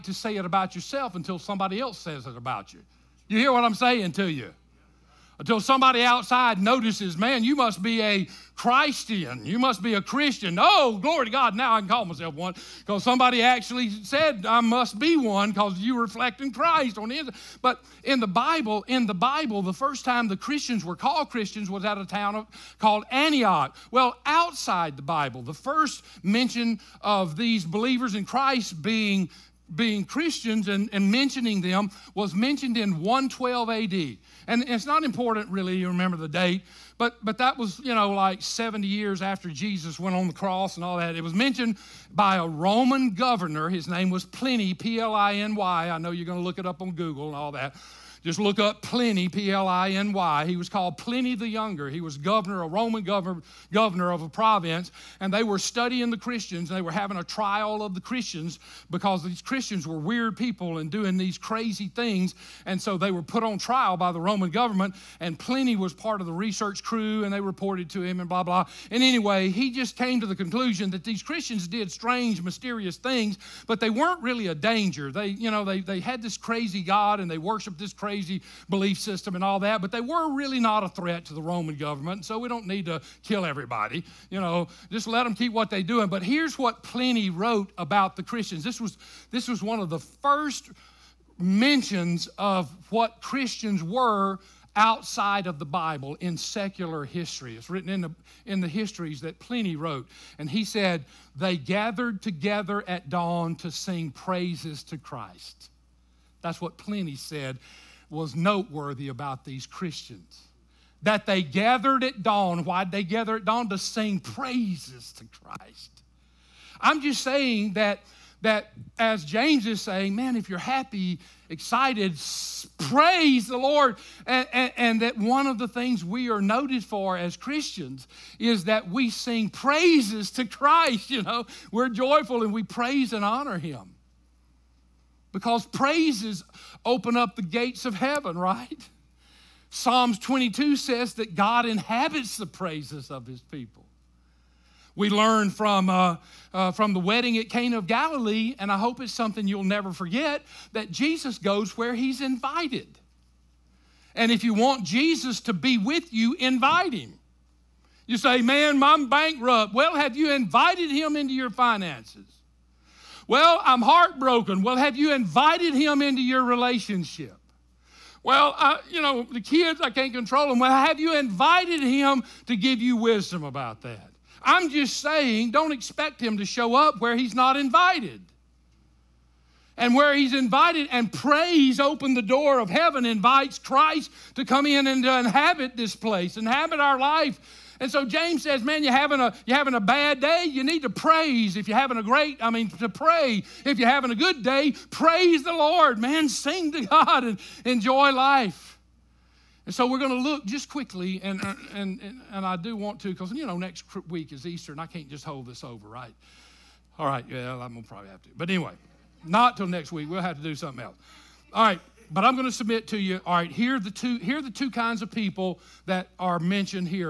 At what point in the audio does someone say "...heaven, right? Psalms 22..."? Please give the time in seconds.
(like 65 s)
137 s.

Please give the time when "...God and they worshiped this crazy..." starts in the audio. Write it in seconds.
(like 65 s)
76 s.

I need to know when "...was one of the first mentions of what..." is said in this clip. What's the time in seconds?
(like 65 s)
89 s.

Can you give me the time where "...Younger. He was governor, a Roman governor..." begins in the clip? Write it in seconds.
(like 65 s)
51 s.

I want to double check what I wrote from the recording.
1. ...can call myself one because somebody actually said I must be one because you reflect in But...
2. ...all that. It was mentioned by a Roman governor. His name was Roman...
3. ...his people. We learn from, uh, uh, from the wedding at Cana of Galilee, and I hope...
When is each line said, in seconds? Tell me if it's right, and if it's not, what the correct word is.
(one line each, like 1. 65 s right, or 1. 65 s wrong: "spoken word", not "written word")
1. 11 s wrong: "Christ", not "But"
2. 40 s wrong: "Pliny", not "Roman"
3. 143 s right.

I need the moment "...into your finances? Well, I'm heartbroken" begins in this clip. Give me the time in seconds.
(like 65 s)
161 s.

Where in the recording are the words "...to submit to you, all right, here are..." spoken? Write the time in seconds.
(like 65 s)
212 s.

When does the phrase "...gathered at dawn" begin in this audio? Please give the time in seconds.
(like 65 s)
111 s.